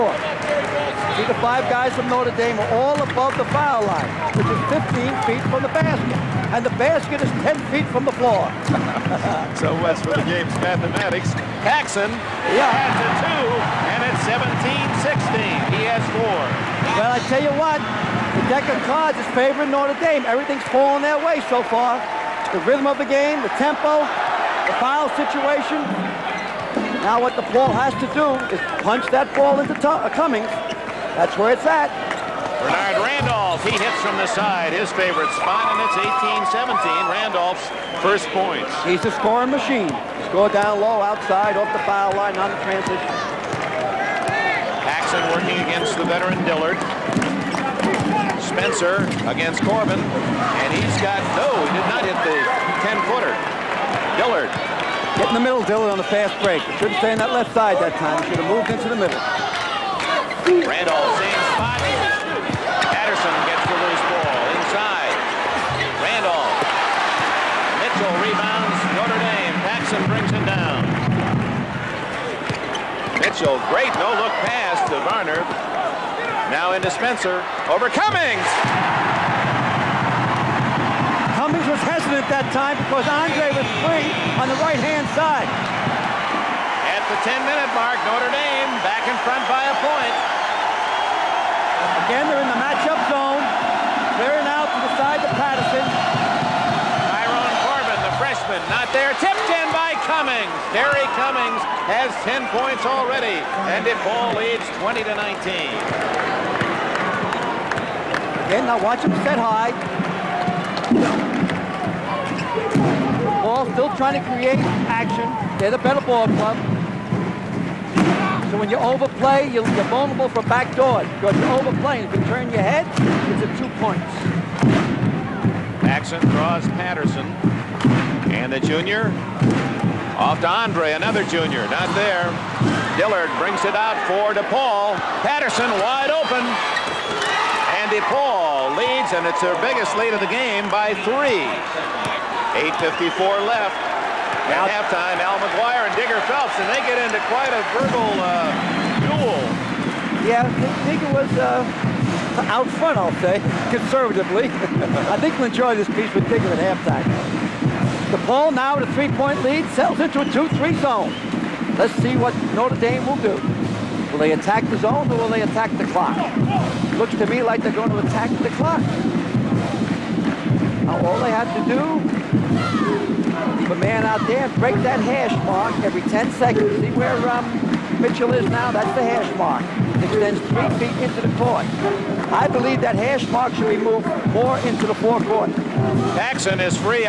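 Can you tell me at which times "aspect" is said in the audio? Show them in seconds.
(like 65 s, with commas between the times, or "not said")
not said.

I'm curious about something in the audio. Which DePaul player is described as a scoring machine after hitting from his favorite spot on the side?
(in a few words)
Bernard Randolph.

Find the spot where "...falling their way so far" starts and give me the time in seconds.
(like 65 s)
20 s.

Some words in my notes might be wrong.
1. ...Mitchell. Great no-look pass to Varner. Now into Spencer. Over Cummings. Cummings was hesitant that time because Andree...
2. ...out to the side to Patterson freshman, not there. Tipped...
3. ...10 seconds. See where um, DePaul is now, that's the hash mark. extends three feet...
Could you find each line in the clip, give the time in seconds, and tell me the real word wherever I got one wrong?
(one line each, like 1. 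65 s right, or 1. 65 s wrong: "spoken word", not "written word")
1. 73 s right
2. 94 s right
3. 176 s wrong: "Mitchell", not "DePaul".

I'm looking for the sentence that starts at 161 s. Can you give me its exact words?
Let's see what Notre Dame will do.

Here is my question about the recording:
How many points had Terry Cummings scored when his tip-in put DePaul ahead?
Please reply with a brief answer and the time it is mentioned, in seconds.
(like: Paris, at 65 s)
10, at 102 s.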